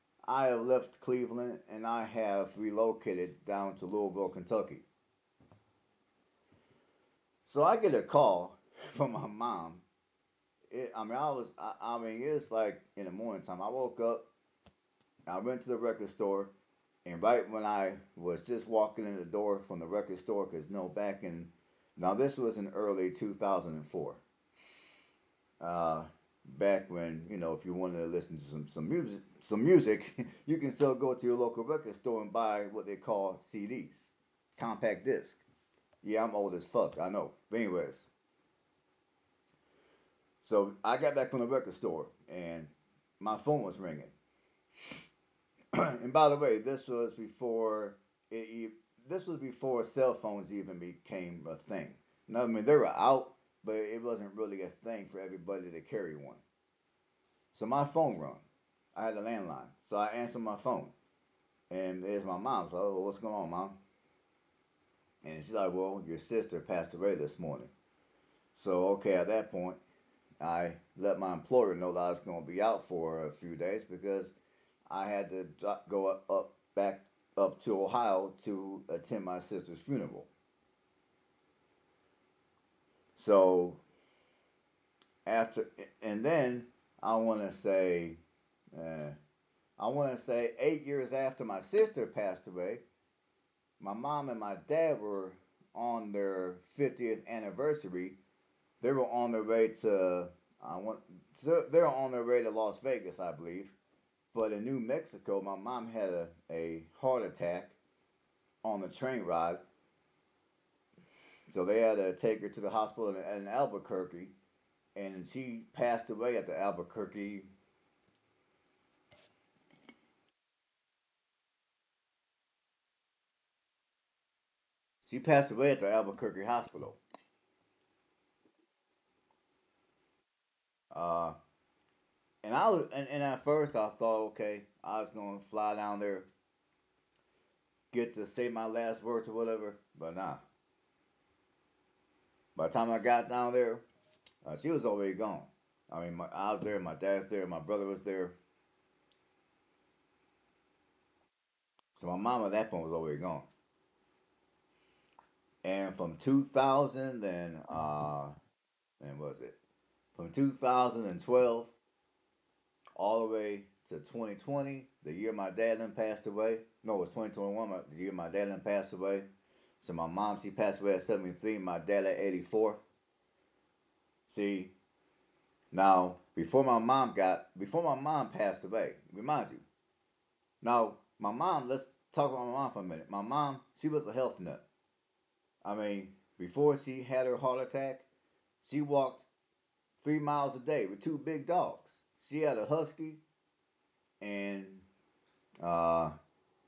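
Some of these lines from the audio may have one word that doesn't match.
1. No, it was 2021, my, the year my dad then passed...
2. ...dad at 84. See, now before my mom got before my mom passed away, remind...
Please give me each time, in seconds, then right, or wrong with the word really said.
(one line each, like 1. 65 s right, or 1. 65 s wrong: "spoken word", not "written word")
1. 166 s right
2. 171 s right.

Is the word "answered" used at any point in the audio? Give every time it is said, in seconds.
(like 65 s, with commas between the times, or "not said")
60 s.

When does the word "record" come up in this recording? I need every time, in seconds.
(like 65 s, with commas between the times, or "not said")
15 s, 19 s, 31 s, 41 s.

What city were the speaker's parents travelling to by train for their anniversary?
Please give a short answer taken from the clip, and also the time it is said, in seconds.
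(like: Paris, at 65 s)
Las Vegas, at 102 s.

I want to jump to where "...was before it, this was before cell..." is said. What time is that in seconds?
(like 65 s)
46 s.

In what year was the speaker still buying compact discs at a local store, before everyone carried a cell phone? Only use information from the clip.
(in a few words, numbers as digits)
2004.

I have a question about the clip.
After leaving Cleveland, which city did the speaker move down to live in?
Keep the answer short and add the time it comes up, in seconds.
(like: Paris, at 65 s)
Louisville, at 3 s.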